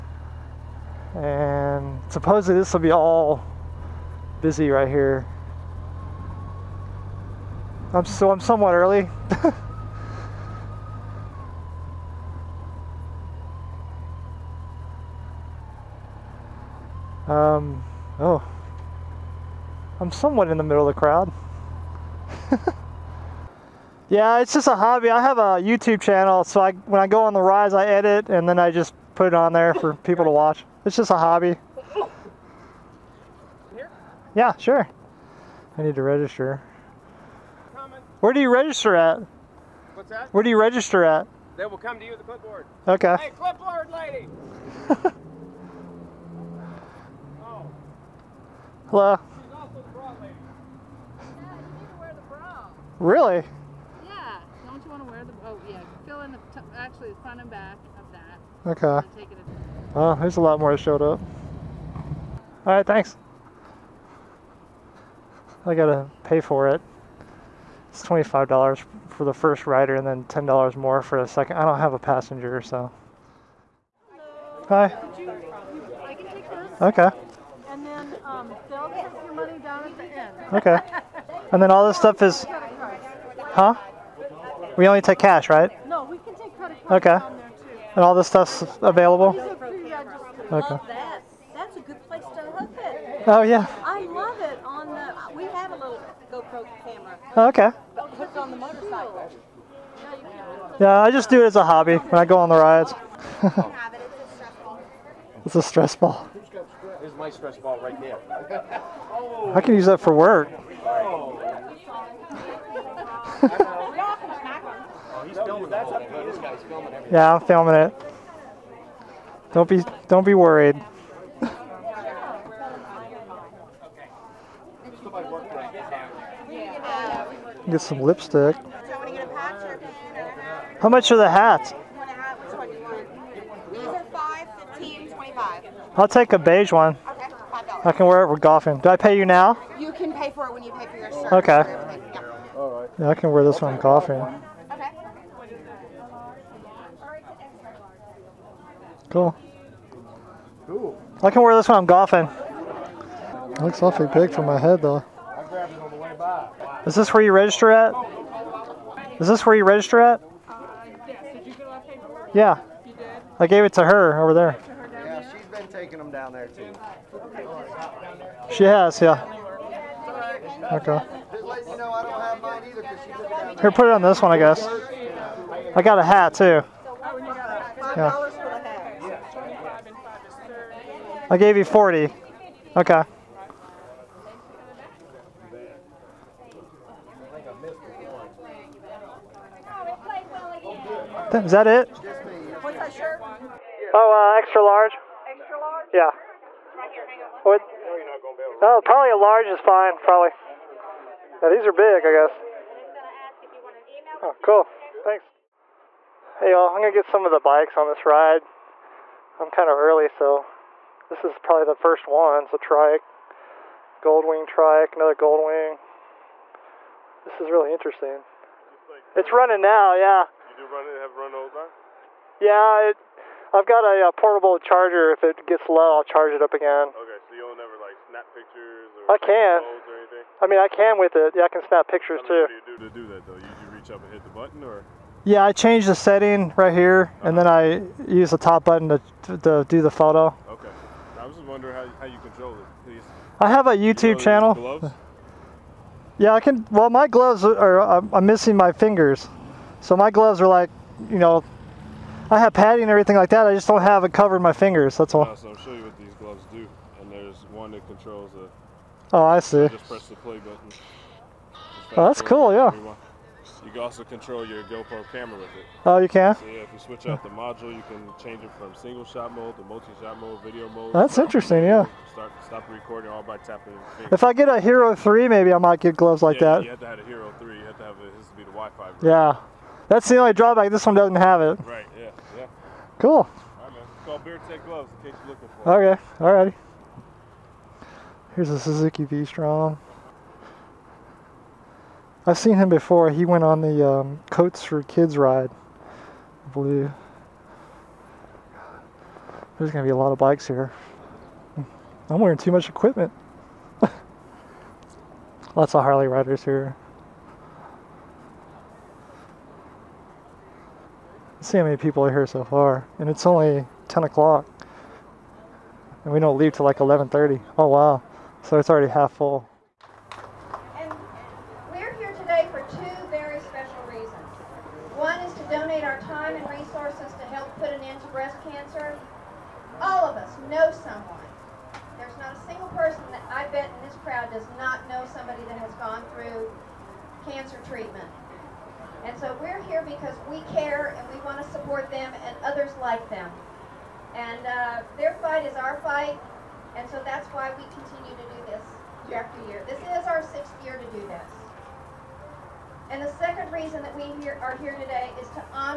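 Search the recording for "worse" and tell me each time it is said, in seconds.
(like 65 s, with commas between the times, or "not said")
not said.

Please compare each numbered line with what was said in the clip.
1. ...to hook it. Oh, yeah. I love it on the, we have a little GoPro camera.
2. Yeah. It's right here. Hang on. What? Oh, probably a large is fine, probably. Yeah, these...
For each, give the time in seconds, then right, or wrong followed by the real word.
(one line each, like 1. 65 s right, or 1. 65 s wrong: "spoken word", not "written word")
1. 92 s right
2. 195 s right.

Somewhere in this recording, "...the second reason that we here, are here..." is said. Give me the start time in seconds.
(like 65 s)
353 s.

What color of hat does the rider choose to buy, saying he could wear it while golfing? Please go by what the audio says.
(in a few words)
beige.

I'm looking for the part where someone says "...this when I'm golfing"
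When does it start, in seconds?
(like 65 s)
151 s.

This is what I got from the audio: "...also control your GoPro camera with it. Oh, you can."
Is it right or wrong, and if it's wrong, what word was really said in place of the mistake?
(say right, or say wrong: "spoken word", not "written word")
right.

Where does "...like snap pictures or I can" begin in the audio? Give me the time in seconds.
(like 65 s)
227 s.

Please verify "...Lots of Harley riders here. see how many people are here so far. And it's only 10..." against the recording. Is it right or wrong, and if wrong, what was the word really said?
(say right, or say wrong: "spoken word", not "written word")
right.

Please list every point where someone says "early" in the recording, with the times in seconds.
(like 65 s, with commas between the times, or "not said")
8 s, 209 s.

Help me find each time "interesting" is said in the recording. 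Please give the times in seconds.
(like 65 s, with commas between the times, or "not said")
217 s, 271 s.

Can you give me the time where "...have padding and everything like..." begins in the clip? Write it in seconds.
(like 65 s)
252 s.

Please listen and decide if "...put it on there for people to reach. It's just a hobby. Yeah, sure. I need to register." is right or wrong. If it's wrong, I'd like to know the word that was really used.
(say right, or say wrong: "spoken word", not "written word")
wrong: "watch", not "reach".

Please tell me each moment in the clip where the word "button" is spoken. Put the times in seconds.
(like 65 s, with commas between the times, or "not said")
234 s, 238 s, 260 s.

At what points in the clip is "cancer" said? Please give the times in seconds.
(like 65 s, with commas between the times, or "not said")
328 s, 337 s.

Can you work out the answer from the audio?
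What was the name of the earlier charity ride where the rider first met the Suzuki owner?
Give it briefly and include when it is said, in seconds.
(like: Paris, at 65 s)
Coats for Kids, at 294 s.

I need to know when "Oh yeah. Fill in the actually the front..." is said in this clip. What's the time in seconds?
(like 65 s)
55 s.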